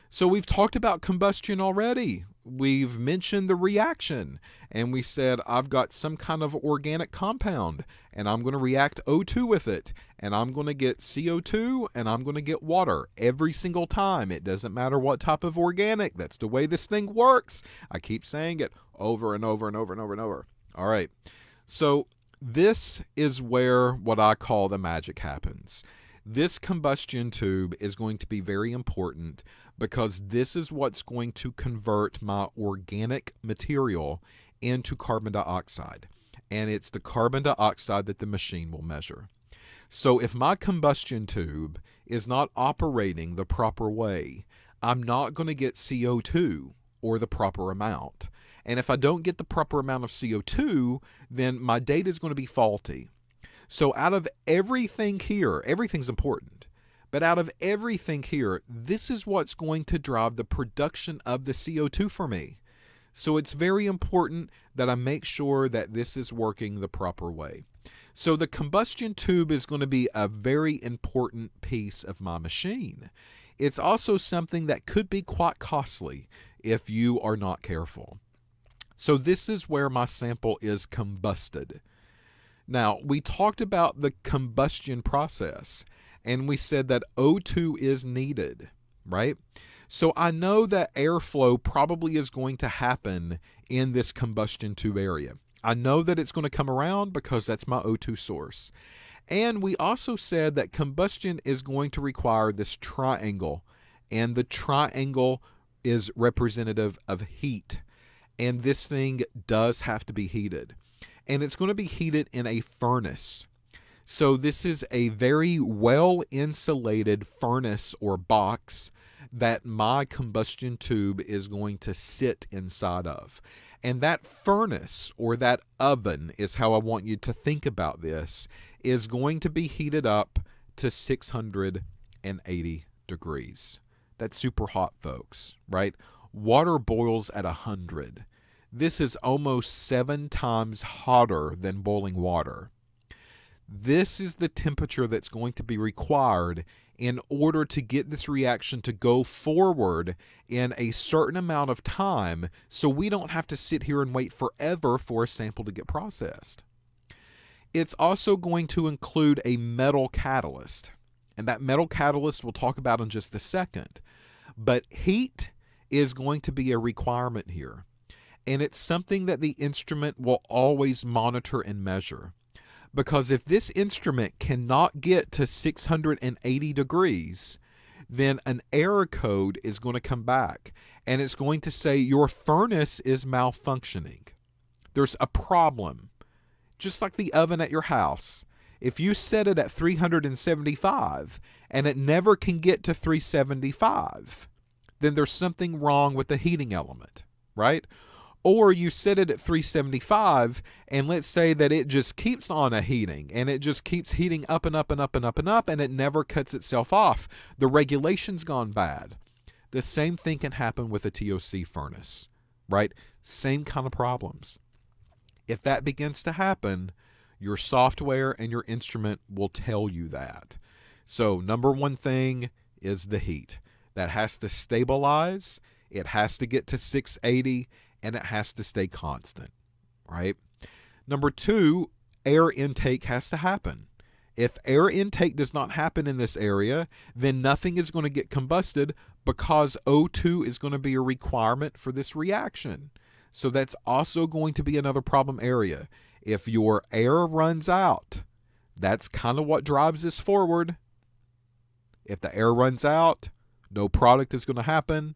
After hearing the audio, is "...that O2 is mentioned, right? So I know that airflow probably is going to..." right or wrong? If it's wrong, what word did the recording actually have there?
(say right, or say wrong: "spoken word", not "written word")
wrong: "needed", not "mentioned".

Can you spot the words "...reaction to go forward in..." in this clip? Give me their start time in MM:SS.
02:28.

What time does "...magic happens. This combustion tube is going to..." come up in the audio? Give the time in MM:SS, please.
00:24.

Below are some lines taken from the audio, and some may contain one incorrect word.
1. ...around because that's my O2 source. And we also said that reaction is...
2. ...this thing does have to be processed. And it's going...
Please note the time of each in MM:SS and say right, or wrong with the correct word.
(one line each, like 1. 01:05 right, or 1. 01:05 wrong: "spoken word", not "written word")
1. 01:36 wrong: "combustion", not "reaction"
2. 01:48 wrong: "heated", not "processed".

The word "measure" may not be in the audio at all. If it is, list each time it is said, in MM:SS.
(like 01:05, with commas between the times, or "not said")
00:38, 02:51.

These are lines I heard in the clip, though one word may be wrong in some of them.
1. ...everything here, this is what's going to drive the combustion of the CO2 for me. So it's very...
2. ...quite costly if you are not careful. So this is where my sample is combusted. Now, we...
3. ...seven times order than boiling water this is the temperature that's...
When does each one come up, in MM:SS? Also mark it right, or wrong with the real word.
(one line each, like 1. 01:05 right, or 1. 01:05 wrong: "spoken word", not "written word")
1. 00:57 wrong: "production", not "combustion"
2. 01:15 right
3. 02:19 wrong: "hotter", not "order".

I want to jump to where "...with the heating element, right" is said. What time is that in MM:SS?
03:16.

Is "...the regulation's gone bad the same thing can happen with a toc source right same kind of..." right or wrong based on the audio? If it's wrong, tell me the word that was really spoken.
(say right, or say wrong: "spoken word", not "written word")
wrong: "furnace", not "source".